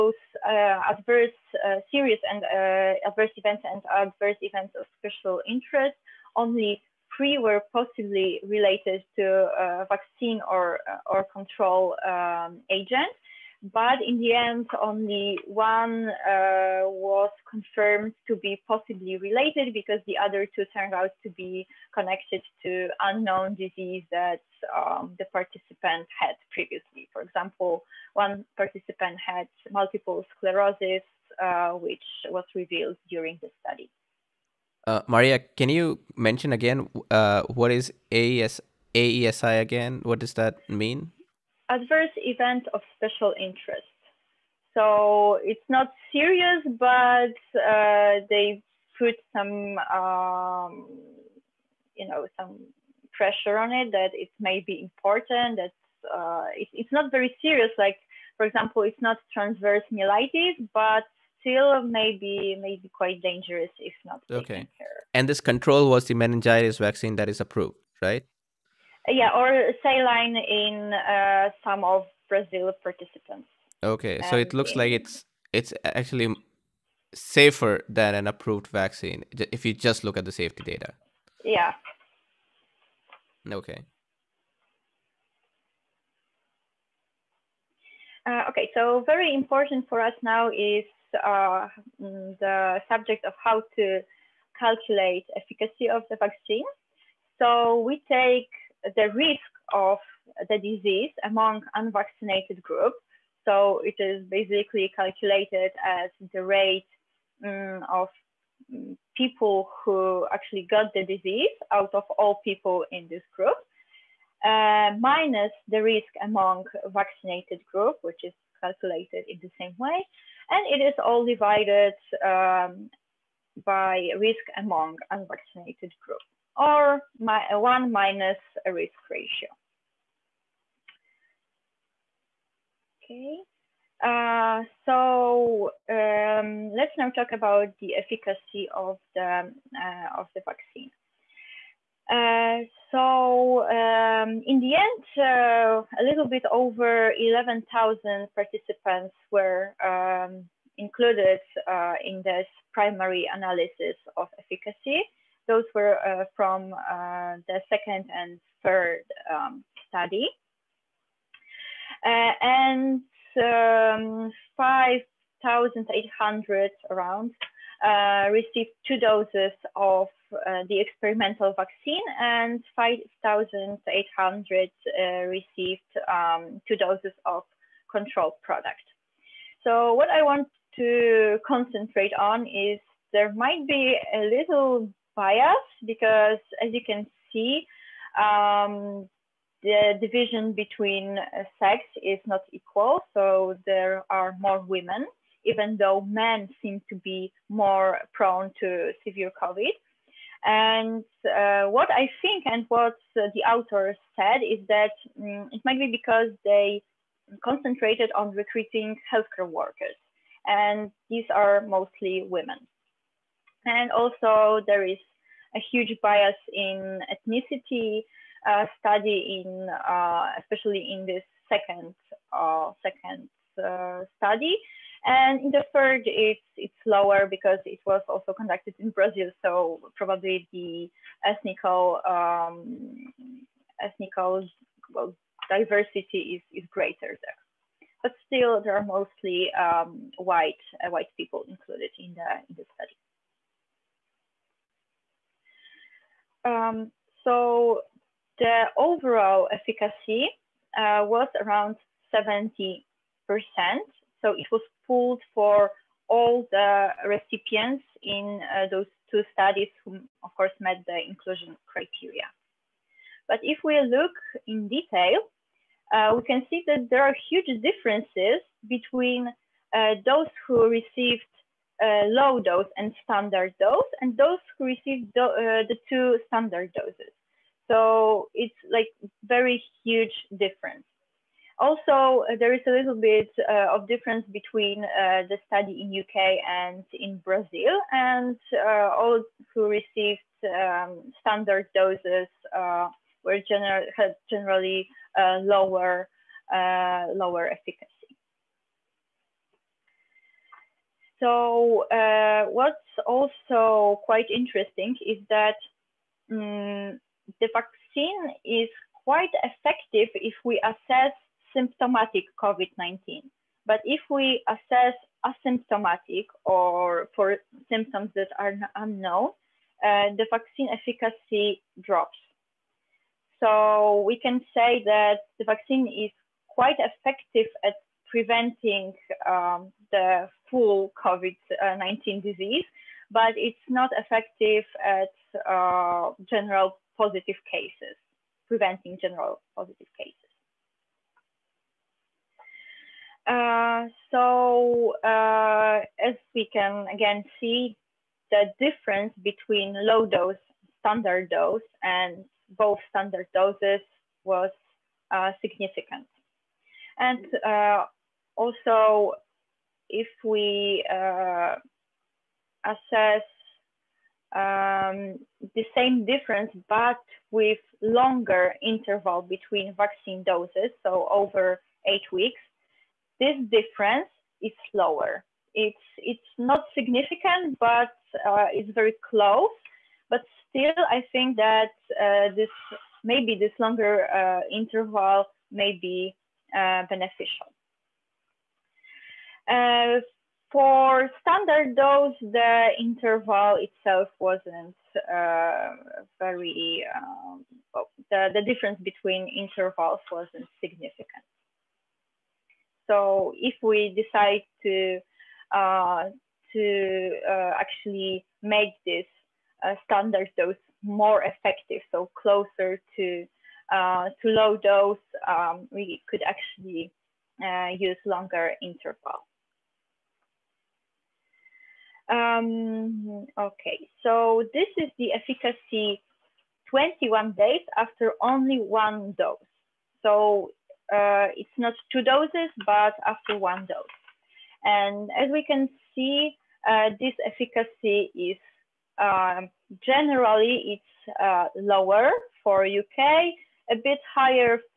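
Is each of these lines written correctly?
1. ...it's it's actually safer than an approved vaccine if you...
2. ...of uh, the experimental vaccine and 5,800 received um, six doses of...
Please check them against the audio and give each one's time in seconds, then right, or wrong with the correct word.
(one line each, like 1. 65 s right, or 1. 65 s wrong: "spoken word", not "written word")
1. 74 s right
2. 169 s wrong: "two", not "six".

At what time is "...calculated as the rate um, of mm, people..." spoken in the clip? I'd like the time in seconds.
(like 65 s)
104 s.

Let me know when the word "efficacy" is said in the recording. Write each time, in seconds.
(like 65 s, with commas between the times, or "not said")
95 s, 137 s, 154 s, 249 s, 297 s, 320 s, 425 s, 437 s.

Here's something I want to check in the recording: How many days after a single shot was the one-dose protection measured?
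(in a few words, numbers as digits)
21.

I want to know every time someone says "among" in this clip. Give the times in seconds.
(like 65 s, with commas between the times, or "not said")
101 s, 116 s, 124 s.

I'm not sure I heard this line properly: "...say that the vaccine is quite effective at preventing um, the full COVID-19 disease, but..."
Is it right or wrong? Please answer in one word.
right.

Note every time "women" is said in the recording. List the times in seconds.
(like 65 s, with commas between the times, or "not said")
194 s, 212 s.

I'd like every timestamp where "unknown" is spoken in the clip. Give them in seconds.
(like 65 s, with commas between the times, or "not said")
23 s, 318 s.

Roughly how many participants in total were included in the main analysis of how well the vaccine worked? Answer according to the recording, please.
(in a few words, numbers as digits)
11,000.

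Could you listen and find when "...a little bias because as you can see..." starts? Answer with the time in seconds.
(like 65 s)
184 s.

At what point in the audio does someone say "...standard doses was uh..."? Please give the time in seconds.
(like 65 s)
352 s.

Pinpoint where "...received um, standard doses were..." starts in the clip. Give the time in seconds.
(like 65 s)
289 s.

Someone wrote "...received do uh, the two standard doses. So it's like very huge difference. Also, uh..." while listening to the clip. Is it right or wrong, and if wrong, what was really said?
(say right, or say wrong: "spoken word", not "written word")
right.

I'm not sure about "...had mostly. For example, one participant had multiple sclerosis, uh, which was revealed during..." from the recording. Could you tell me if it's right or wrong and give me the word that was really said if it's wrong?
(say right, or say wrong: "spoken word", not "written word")
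wrong: "previously", not "mostly".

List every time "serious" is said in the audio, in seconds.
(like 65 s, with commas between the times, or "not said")
1 s, 46 s, 57 s.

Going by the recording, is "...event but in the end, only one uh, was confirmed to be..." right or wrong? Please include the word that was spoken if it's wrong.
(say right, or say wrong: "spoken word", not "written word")
wrong: "agent", not "event".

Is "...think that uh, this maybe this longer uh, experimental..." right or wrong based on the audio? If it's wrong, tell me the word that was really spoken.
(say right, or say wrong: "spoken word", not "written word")
wrong: "interval", not "experimental".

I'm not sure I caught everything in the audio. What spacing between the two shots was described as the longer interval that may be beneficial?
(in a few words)
over 8 weeks.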